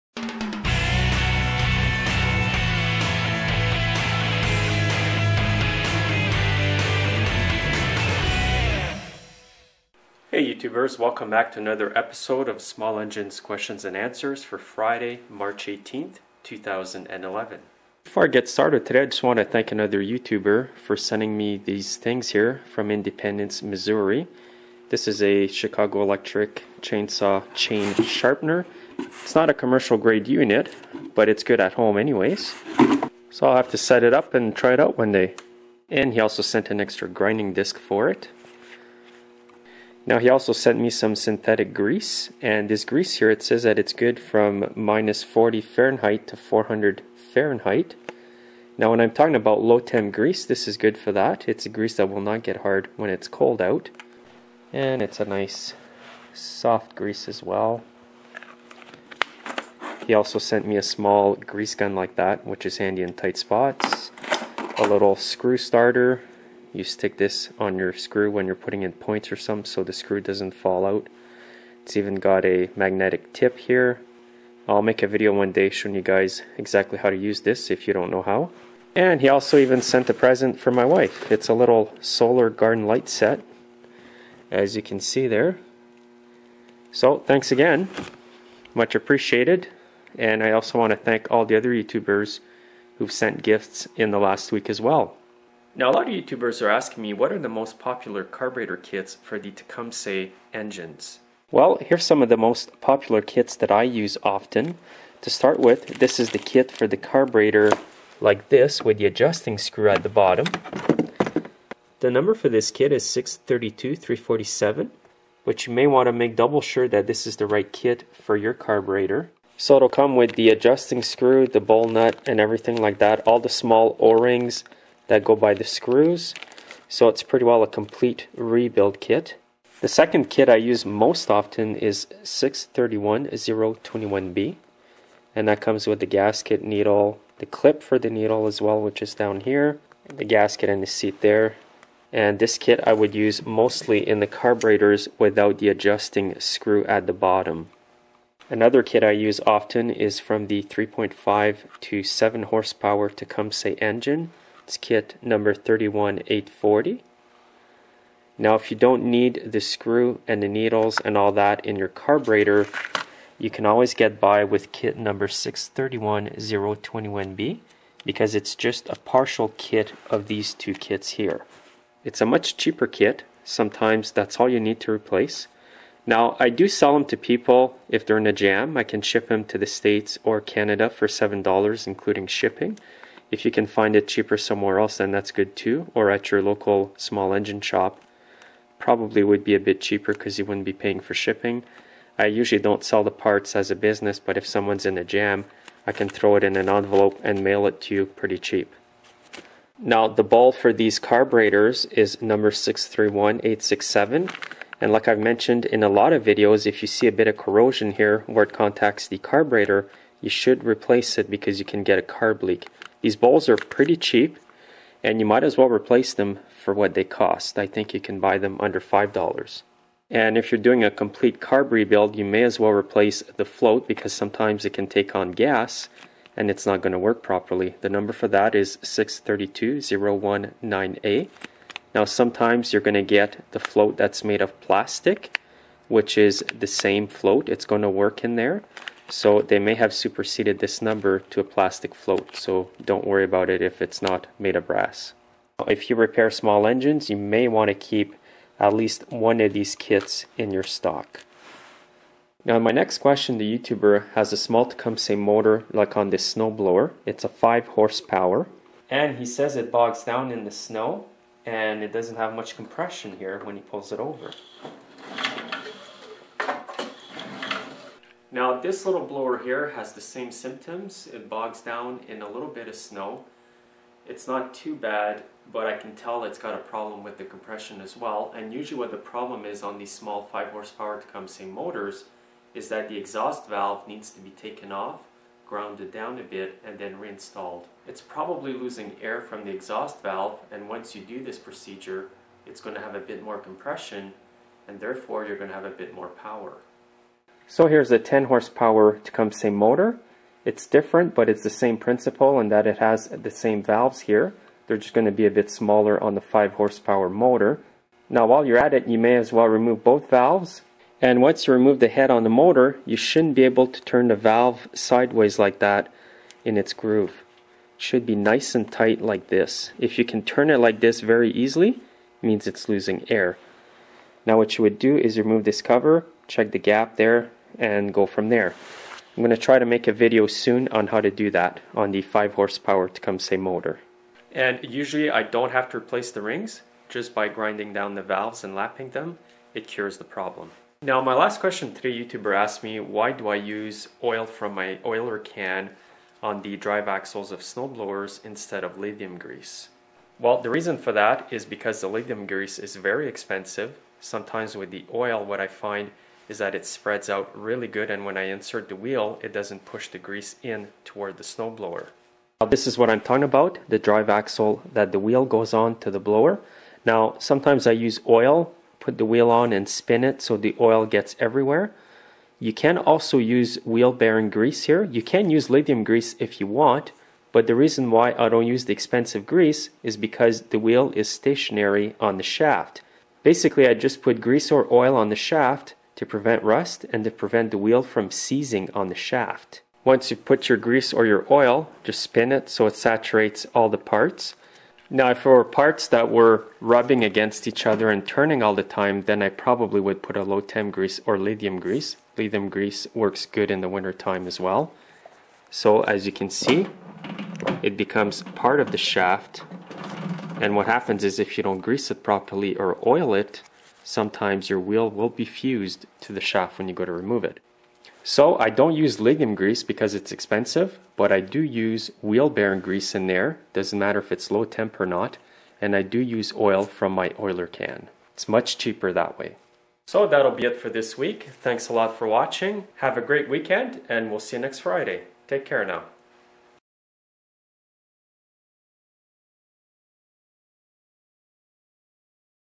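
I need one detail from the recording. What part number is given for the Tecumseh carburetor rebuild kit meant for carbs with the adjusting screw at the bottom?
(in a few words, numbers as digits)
632347.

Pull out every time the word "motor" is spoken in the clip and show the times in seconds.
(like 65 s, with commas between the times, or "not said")
255 s, 281 s, 299 s, 307 s, 312 s, 333 s.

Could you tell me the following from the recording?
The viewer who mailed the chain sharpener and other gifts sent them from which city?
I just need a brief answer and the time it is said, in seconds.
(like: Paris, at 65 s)
Independence, Missouri, at 22 s.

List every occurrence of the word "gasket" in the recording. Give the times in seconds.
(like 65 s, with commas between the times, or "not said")
136 s, 140 s.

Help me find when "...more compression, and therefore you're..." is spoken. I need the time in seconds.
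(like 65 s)
293 s.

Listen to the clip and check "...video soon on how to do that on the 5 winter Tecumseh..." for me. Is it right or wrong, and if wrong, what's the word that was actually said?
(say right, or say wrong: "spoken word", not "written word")
wrong: "horsepower", not "winter".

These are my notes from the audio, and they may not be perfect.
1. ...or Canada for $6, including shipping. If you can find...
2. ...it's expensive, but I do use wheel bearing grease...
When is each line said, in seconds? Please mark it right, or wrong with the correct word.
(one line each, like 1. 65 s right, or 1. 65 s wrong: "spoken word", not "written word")
1. 180 s wrong: "7", not "6"
2. 419 s right.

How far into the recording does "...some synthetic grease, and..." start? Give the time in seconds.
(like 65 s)
40 s.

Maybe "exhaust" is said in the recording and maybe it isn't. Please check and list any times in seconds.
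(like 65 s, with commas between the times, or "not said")
282 s, 289 s.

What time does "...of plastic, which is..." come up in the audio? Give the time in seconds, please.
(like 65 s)
234 s.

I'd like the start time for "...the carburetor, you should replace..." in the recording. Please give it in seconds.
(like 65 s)
209 s.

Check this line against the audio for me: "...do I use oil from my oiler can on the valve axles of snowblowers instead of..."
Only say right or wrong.
wrong.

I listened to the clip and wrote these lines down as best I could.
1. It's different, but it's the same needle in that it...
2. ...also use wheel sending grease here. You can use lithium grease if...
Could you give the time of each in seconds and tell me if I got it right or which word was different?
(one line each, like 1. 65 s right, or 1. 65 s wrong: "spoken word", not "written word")
1. 300 s wrong: "principle", not "needle"
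2. 372 s wrong: "bearing", not "sending".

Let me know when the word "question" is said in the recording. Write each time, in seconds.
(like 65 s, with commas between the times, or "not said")
13 s, 252 s, 341 s.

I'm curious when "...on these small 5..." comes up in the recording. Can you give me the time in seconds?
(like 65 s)
279 s.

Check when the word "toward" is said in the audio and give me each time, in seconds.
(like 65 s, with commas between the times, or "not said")
360 s.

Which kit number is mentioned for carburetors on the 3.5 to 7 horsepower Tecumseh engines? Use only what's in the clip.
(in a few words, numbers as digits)
31840.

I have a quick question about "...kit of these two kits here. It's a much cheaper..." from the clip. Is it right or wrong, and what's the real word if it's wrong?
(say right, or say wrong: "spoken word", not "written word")
right.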